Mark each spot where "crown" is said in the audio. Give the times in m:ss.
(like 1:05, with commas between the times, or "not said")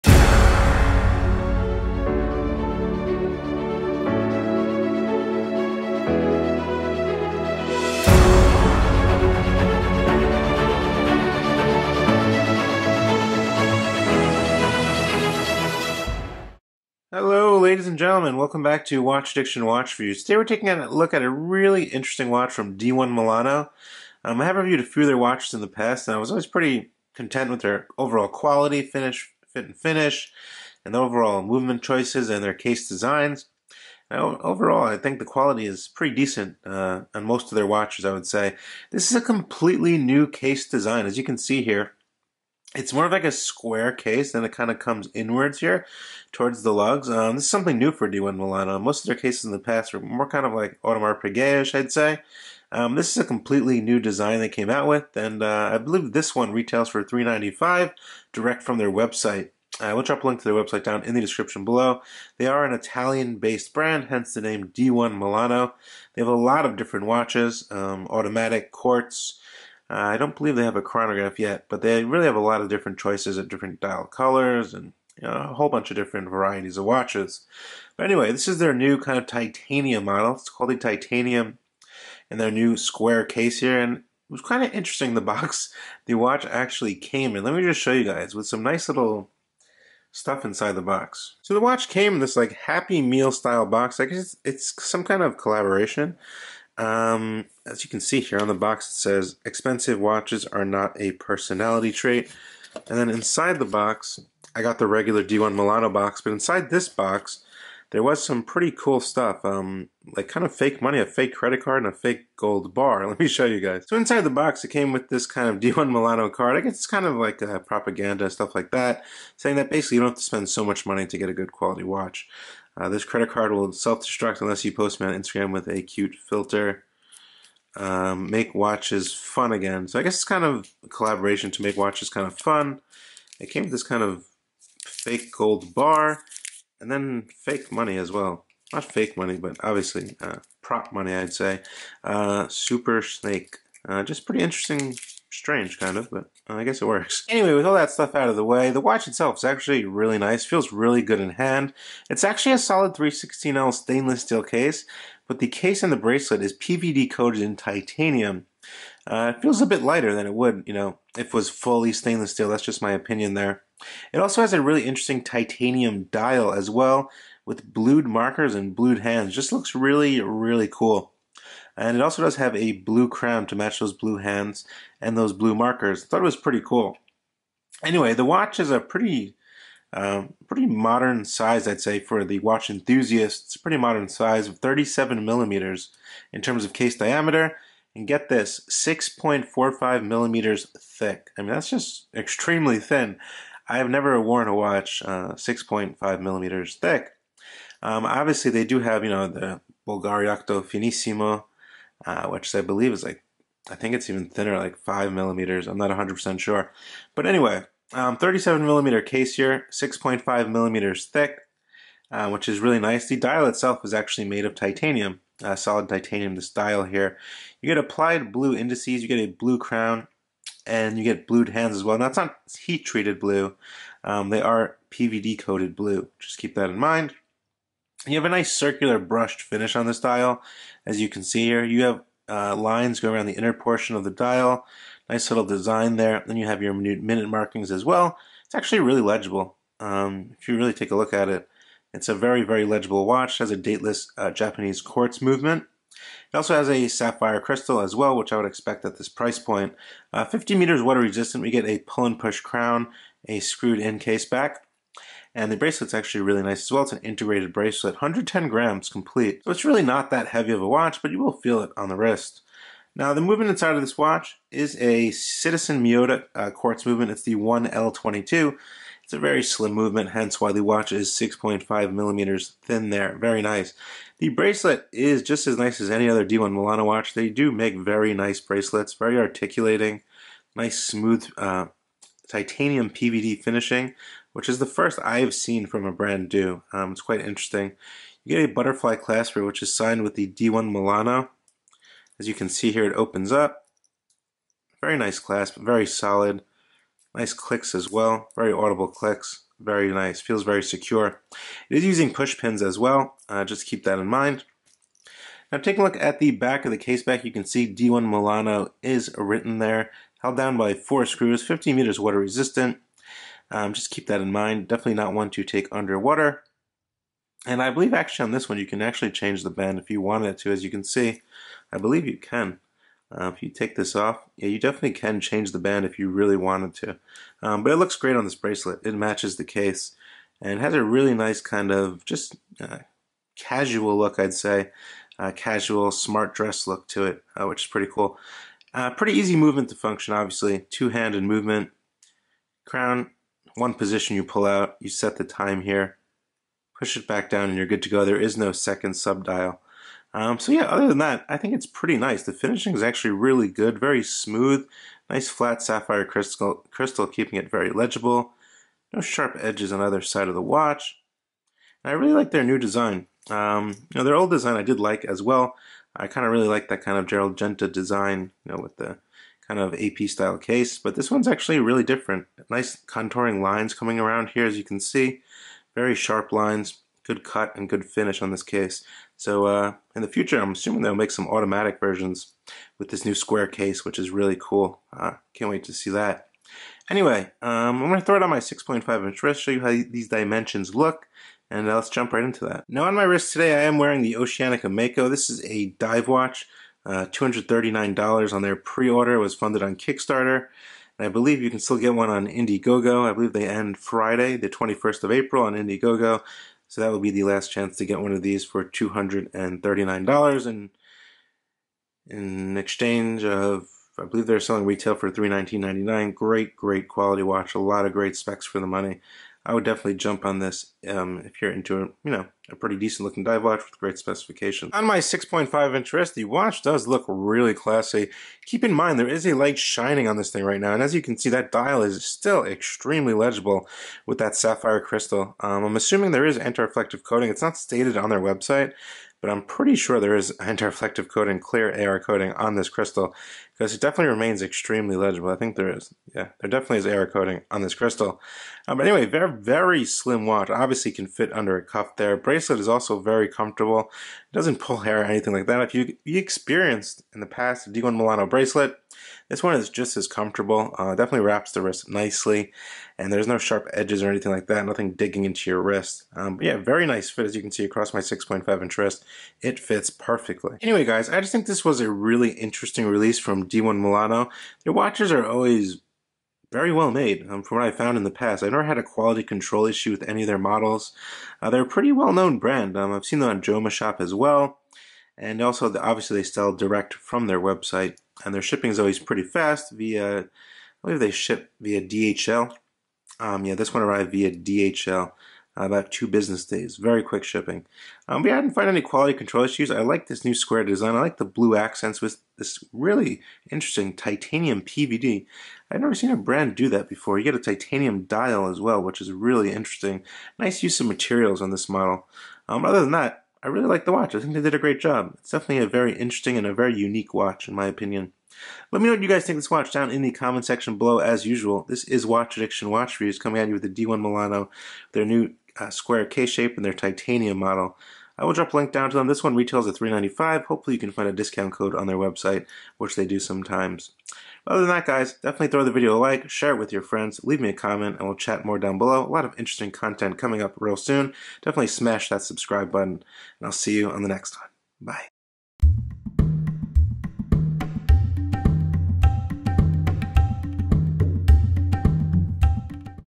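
2:53, 3:39, 4:12, 5:42.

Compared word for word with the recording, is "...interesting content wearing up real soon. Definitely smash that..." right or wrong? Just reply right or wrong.
wrong.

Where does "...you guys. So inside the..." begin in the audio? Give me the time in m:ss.
1:53.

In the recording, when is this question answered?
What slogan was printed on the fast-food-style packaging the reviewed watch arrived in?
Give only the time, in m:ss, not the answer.
1:39.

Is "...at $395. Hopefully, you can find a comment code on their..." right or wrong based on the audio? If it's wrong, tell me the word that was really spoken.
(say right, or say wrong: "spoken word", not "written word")
wrong: "discount", not "comment".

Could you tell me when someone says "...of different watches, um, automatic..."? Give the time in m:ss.
1:06.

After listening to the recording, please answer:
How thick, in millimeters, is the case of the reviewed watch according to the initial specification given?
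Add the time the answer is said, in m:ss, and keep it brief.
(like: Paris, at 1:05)
6.45 mm, at 3:08.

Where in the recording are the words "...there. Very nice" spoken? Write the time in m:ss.
4:32.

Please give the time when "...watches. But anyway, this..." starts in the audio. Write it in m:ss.
1:16.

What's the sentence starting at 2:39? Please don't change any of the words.
Uh, it feels a bit lighter than it would, you know, if it was fully stainless steel.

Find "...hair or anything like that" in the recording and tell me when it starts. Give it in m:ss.
7:34.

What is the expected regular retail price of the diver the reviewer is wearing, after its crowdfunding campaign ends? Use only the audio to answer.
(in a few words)
$319.99.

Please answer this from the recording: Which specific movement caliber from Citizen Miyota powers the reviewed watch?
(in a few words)
1L22.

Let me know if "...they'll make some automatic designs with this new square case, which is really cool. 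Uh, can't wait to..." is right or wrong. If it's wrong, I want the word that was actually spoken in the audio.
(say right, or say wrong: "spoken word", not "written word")
wrong: "versions", not "designs".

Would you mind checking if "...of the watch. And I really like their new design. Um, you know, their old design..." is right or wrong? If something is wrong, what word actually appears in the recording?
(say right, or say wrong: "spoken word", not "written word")
right.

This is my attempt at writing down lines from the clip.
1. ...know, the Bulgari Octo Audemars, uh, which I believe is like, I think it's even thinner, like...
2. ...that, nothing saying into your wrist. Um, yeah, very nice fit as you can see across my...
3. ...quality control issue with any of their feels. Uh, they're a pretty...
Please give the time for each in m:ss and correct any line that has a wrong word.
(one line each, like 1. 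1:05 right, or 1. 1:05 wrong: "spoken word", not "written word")
1. 3:19 wrong: "Finissimo", not "Audemars"
2. 7:44 wrong: "digging", not "saying"
3. 7:58 wrong: "models", not "feels".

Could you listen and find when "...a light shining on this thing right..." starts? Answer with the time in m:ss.
7:09.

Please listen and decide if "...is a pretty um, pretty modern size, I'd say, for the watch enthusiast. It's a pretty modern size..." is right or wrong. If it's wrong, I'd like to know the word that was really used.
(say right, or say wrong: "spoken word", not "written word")
right.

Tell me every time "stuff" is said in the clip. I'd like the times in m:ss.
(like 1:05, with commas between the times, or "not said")
1:30, 1:49, 1:58, 2:27.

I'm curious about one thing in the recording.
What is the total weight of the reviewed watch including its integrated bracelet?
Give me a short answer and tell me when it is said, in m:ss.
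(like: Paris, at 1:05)
110 grams, at 4:17.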